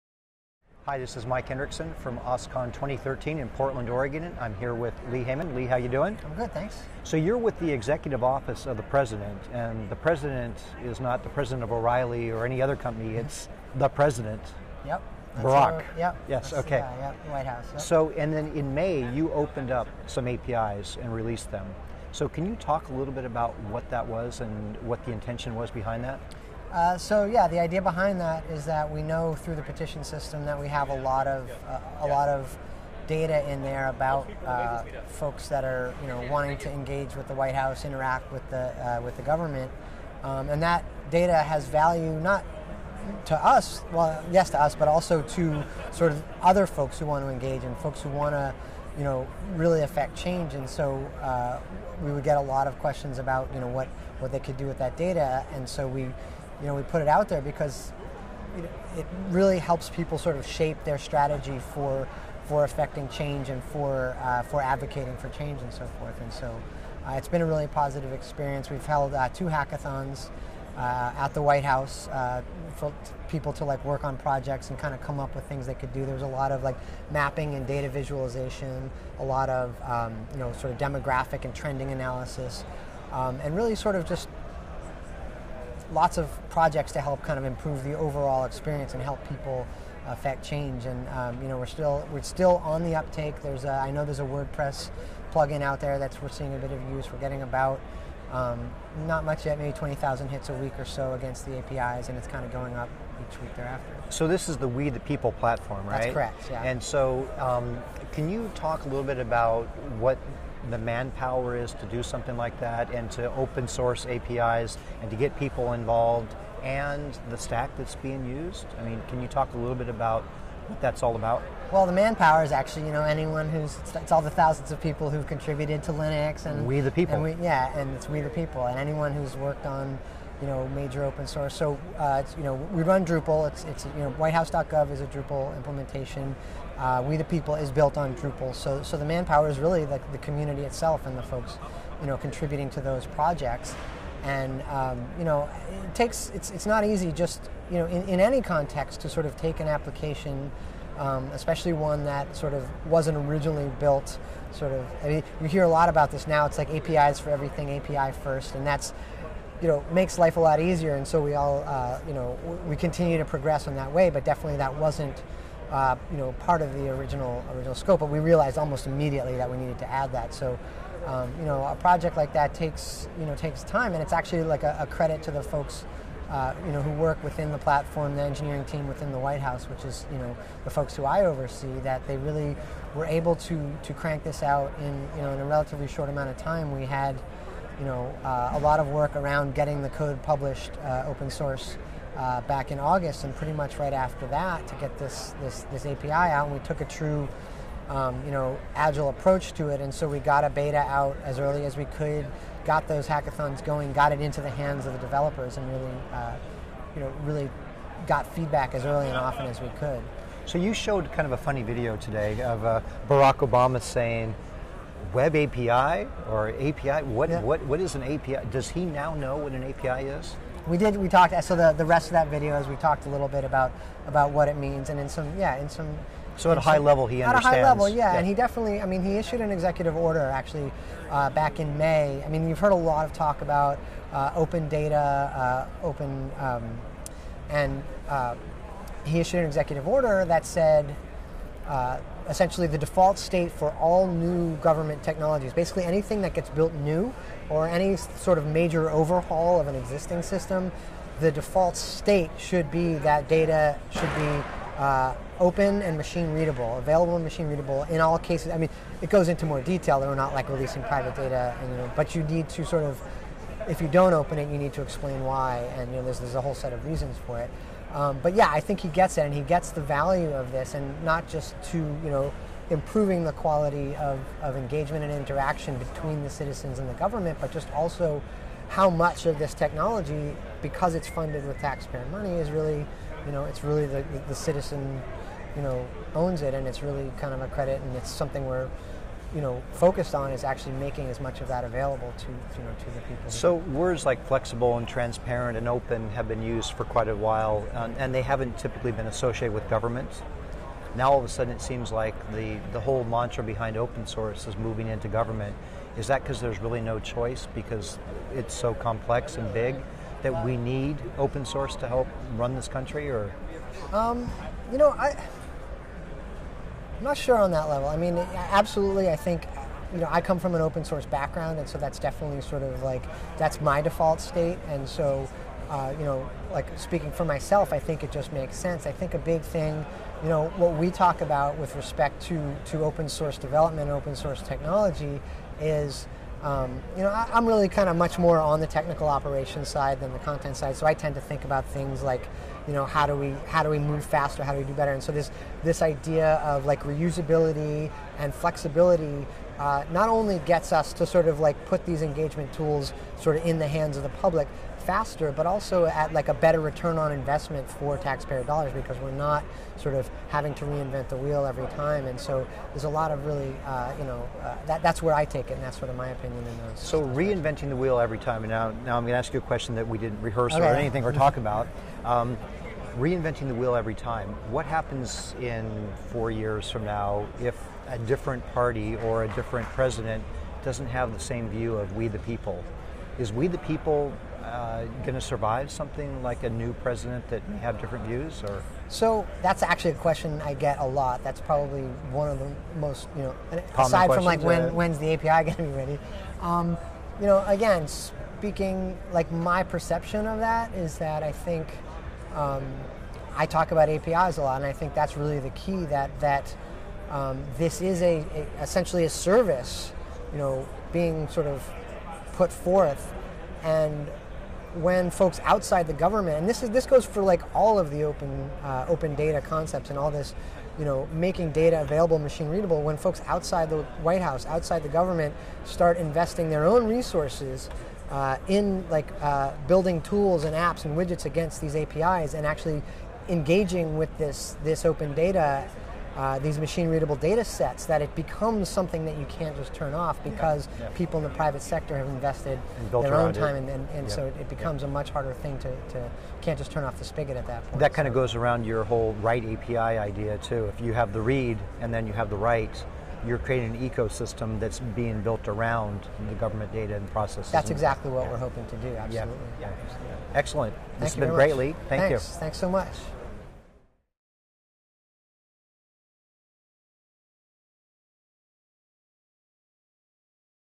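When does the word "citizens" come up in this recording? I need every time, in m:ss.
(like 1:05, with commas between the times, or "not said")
4:36, 4:44.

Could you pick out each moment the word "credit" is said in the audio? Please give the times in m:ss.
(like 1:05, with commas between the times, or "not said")
2:54, 4:47.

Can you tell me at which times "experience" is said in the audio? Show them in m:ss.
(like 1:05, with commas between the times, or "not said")
1:08, 1:28.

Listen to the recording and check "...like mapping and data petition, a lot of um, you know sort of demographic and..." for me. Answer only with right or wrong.
wrong.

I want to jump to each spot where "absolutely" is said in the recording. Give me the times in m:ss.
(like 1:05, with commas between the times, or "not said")
5:18, 7:38.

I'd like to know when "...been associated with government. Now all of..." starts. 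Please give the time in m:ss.
4:58.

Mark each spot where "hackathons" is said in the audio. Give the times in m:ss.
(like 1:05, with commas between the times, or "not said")
1:09, 3:23.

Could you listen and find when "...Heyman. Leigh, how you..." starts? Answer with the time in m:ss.
0:05.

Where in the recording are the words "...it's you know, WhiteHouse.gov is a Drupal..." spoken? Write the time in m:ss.
2:13.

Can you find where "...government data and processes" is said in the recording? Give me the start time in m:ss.
7:36.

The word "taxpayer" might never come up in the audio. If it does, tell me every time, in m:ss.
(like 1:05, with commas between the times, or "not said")
4:41, 5:57.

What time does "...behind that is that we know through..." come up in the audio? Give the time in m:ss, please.
0:27.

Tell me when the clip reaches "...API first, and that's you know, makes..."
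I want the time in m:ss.
2:37.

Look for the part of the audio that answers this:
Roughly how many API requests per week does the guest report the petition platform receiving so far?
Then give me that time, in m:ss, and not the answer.
1:39.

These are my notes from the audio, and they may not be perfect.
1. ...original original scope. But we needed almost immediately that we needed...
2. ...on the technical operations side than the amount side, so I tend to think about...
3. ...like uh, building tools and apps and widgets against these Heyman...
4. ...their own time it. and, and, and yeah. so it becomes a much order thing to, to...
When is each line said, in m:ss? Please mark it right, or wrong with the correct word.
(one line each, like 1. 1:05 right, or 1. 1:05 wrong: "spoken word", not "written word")
1. 2:46 wrong: "realized", not "needed"
2. 5:38 wrong: "content", not "amount"
3. 7:08 wrong: "APIs", not "Heyman"
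4. 7:22 wrong: "harder", not "order".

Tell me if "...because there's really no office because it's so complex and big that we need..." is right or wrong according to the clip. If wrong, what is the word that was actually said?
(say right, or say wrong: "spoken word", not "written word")
wrong: "choice", not "office".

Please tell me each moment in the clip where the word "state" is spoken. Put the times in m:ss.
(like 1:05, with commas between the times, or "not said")
4:03, 4:11, 5:24.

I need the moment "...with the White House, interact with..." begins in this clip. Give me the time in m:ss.
0:37.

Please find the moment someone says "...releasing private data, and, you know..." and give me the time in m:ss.
4:20.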